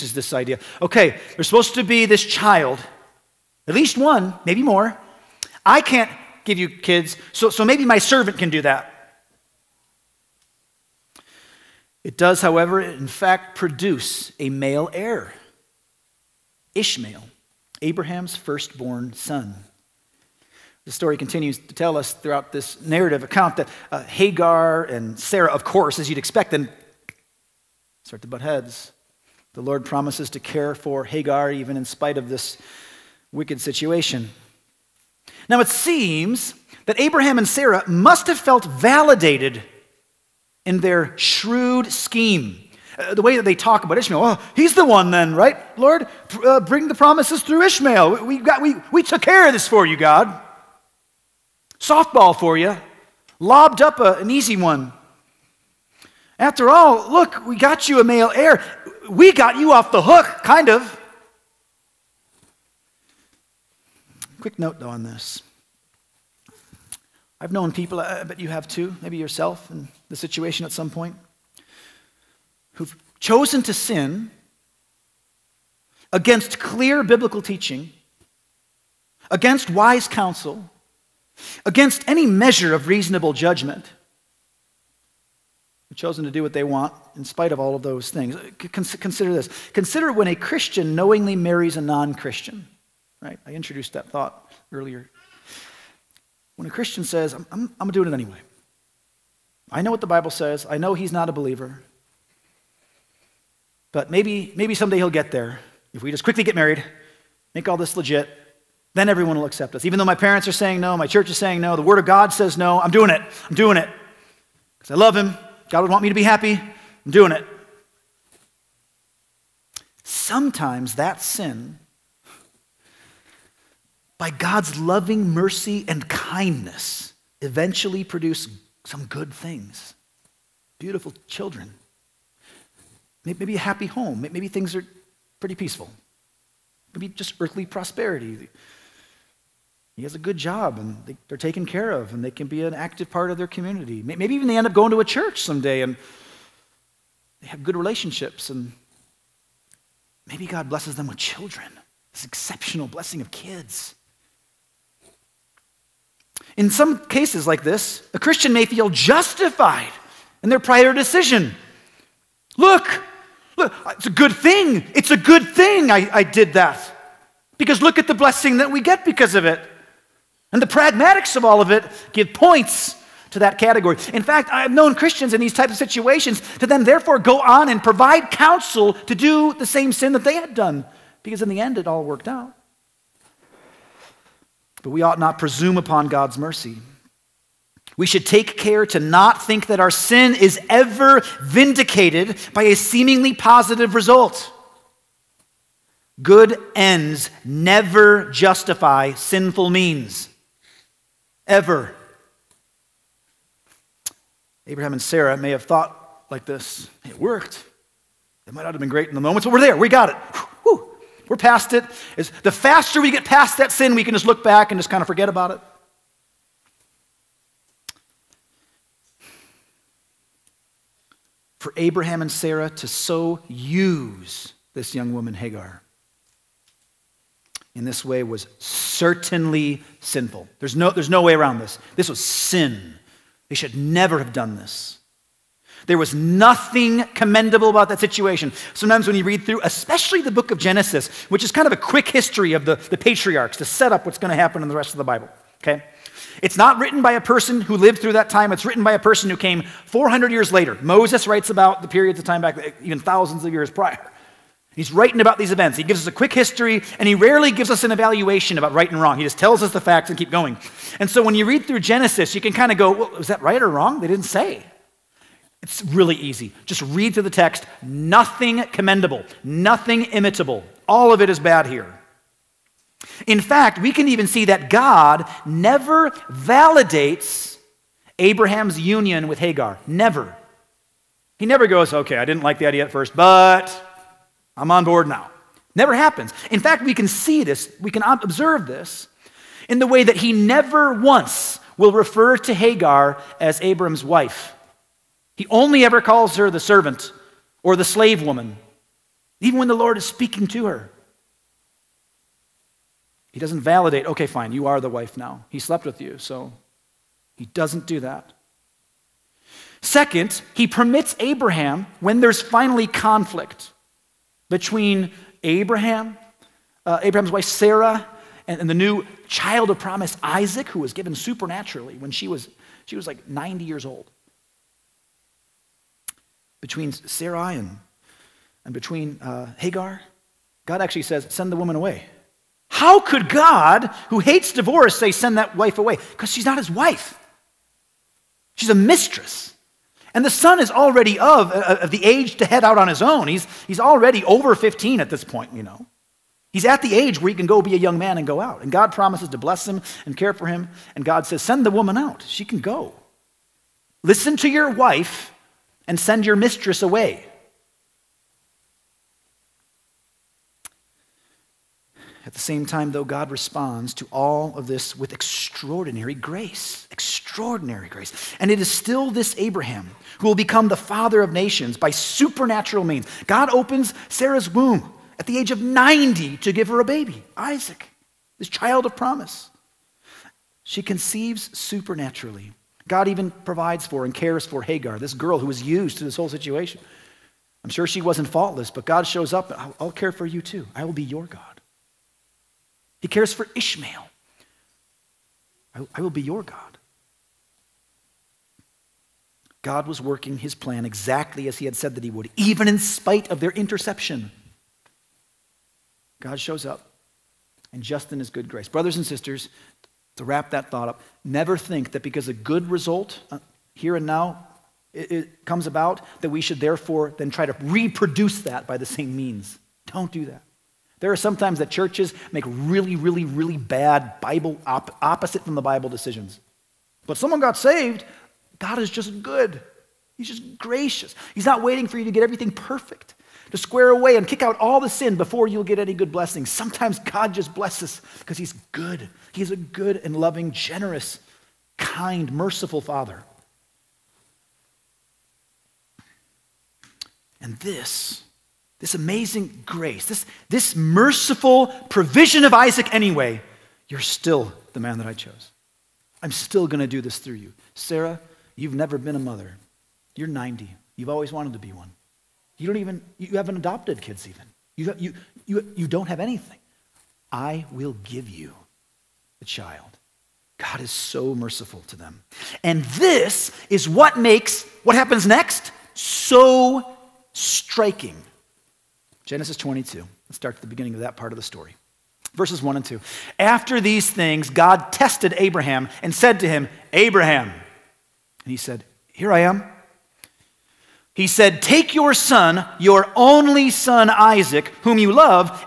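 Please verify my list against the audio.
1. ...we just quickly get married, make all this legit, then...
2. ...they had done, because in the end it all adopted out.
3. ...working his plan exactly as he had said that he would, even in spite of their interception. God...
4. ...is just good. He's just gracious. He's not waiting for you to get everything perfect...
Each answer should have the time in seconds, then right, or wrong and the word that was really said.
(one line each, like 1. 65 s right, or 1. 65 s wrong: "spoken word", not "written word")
1. 106 s right
2. 180 s wrong: "worked", not "adopted"
3. 399 s right
4. 428 s right.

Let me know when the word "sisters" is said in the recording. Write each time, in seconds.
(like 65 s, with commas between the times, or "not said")
409 s.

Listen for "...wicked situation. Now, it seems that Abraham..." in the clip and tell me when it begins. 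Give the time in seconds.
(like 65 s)
33 s.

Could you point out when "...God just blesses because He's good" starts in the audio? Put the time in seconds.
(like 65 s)
436 s.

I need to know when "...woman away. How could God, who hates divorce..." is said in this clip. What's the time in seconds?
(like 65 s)
331 s.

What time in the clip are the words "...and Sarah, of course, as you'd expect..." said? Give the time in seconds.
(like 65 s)
24 s.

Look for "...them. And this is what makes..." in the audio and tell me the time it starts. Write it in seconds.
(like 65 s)
471 s.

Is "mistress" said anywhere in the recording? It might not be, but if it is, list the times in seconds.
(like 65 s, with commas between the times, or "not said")
338 s, 356 s.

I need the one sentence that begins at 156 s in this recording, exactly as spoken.
In some cases like this, a Christian may feel justified in their prior decision.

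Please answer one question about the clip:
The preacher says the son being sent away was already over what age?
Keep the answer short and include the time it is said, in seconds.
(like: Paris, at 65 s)
15, at 344 s.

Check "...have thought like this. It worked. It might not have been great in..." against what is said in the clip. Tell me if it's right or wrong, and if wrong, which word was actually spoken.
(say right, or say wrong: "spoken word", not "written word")
right.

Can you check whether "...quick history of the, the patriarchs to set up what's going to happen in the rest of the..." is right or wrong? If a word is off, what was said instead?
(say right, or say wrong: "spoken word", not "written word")
right.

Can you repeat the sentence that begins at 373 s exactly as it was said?
God opens Sarah's womb at the age of 90 to give her a baby, Isaac, this child of promise.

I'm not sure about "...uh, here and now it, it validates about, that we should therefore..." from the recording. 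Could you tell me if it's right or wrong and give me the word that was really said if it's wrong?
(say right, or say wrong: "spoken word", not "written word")
wrong: "comes", not "validates".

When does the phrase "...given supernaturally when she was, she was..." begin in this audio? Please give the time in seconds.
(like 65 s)
320 s.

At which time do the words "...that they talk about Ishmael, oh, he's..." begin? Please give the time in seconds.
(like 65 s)
43 s.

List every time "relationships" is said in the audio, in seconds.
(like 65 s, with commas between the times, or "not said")
147 s.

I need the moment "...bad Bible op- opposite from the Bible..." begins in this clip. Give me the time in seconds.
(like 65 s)
423 s.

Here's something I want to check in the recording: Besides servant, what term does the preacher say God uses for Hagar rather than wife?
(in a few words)
Slave woman.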